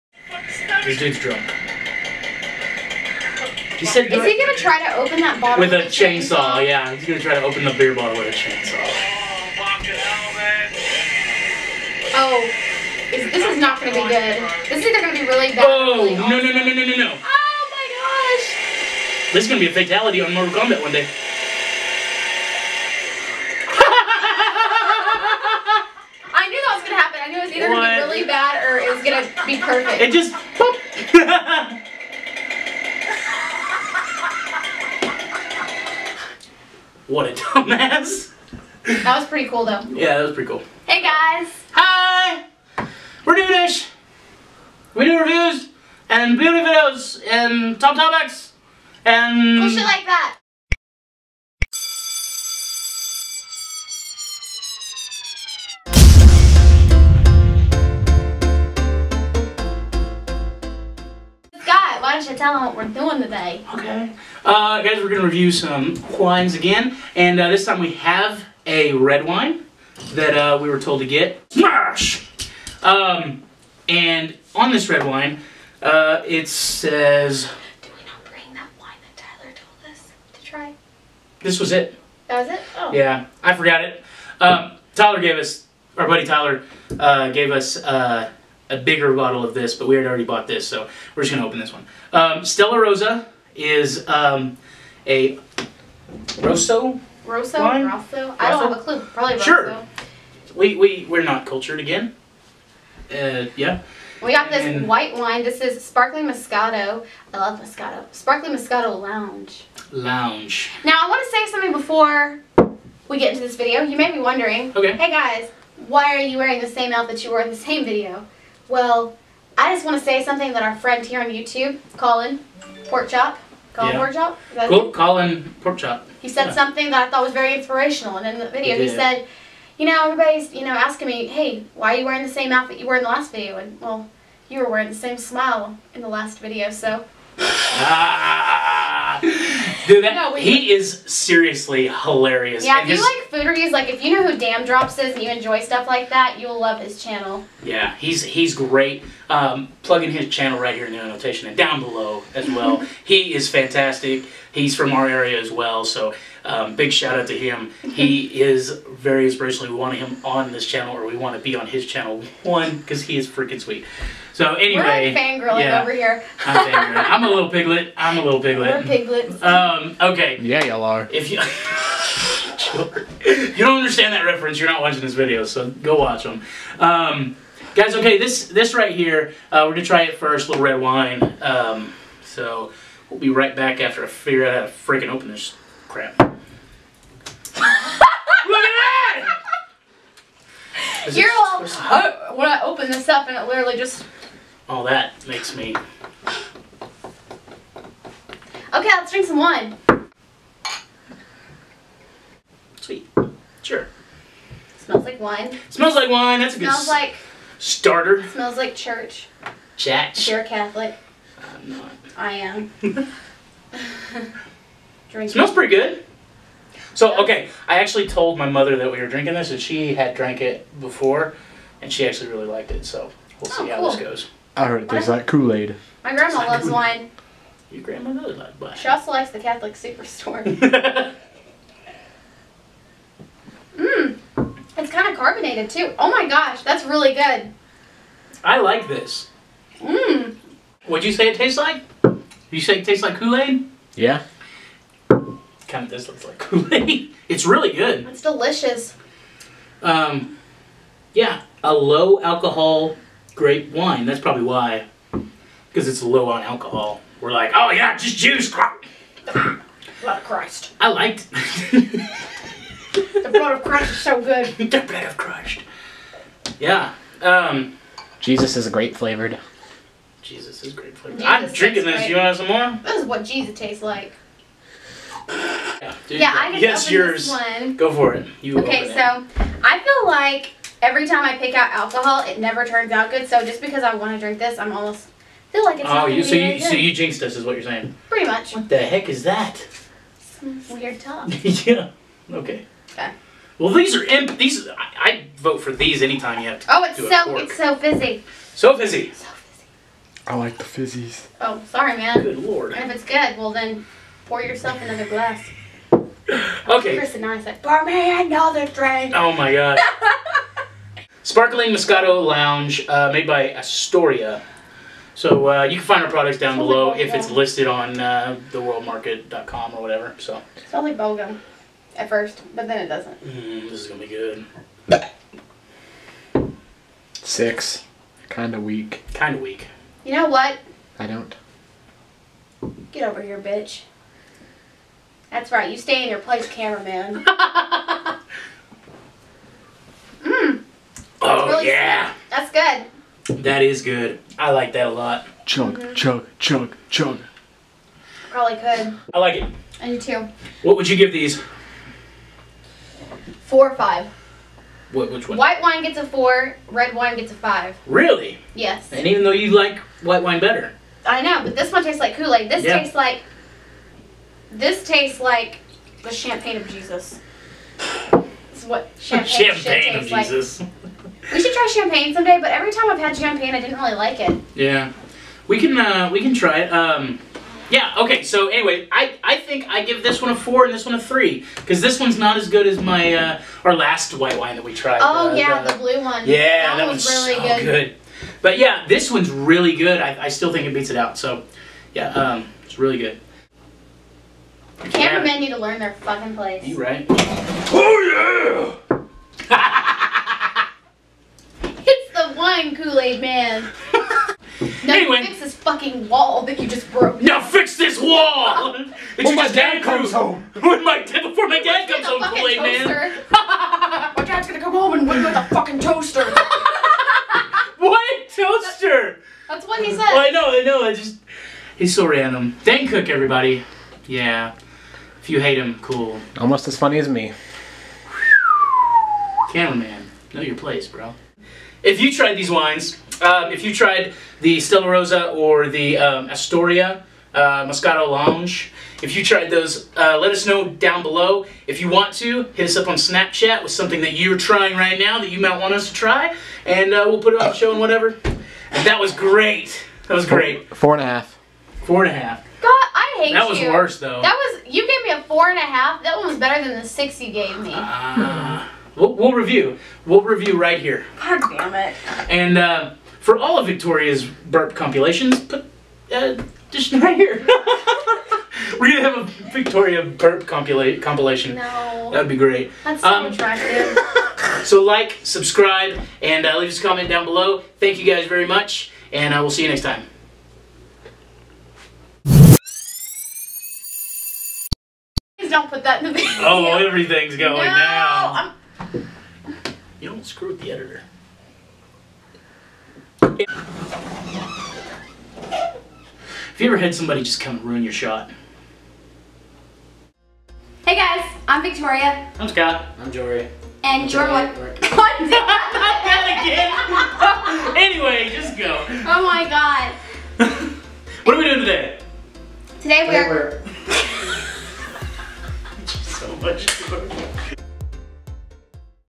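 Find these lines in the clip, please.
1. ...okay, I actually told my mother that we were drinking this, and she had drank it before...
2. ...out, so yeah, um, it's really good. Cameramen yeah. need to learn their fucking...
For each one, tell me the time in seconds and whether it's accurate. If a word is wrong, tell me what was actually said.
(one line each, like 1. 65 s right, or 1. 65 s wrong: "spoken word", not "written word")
1. 217 s right
2. 390 s right.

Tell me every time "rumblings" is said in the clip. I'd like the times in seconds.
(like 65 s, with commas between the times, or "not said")
not said.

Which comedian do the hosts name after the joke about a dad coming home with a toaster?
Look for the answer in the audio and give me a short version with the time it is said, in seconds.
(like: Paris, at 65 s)
Dane Cook, at 422 s.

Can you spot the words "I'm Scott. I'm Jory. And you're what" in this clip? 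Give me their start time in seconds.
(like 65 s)
502 s.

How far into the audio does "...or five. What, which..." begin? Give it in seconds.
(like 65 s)
353 s.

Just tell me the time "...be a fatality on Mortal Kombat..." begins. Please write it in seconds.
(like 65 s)
19 s.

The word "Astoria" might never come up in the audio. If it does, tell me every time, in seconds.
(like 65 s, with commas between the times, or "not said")
313 s, 436 s.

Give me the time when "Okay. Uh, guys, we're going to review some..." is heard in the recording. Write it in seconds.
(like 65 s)
63 s.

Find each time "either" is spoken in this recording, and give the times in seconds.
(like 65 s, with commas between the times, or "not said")
14 s, 27 s.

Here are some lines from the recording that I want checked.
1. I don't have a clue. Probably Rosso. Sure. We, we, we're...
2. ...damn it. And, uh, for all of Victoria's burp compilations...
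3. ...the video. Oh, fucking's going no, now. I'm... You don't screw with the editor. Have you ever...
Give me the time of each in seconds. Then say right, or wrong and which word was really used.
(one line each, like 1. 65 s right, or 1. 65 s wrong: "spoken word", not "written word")
1. 97 s right
2. 461 s right
3. 486 s wrong: "everything", not "fucking".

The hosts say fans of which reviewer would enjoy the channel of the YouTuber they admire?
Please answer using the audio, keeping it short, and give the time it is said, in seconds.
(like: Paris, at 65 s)
Daym Drops, at 144 s.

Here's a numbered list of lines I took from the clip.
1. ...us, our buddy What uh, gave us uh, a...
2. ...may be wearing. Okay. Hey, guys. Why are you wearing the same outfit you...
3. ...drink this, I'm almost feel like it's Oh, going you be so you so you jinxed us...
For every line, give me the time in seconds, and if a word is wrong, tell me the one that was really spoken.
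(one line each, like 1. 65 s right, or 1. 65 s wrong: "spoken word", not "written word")
1. 85 s wrong: "Tyler", not "What"
2. 113 s wrong: "wondering", not "wearing"
3. 284 s right.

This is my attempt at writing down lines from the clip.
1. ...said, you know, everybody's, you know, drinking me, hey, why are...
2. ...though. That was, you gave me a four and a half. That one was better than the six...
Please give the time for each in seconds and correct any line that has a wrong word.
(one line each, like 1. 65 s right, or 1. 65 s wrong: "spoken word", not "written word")
1. 128 s wrong: "asking", not "drinking"
2. 453 s right.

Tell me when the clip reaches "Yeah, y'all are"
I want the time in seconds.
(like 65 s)
170 s.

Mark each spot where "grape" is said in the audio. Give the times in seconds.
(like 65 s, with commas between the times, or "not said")
253 s, 268 s.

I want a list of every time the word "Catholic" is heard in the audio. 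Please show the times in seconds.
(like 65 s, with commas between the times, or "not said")
210 s, 229 s.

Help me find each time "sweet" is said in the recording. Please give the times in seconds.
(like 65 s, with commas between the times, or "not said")
163 s, 202 s, 342 s.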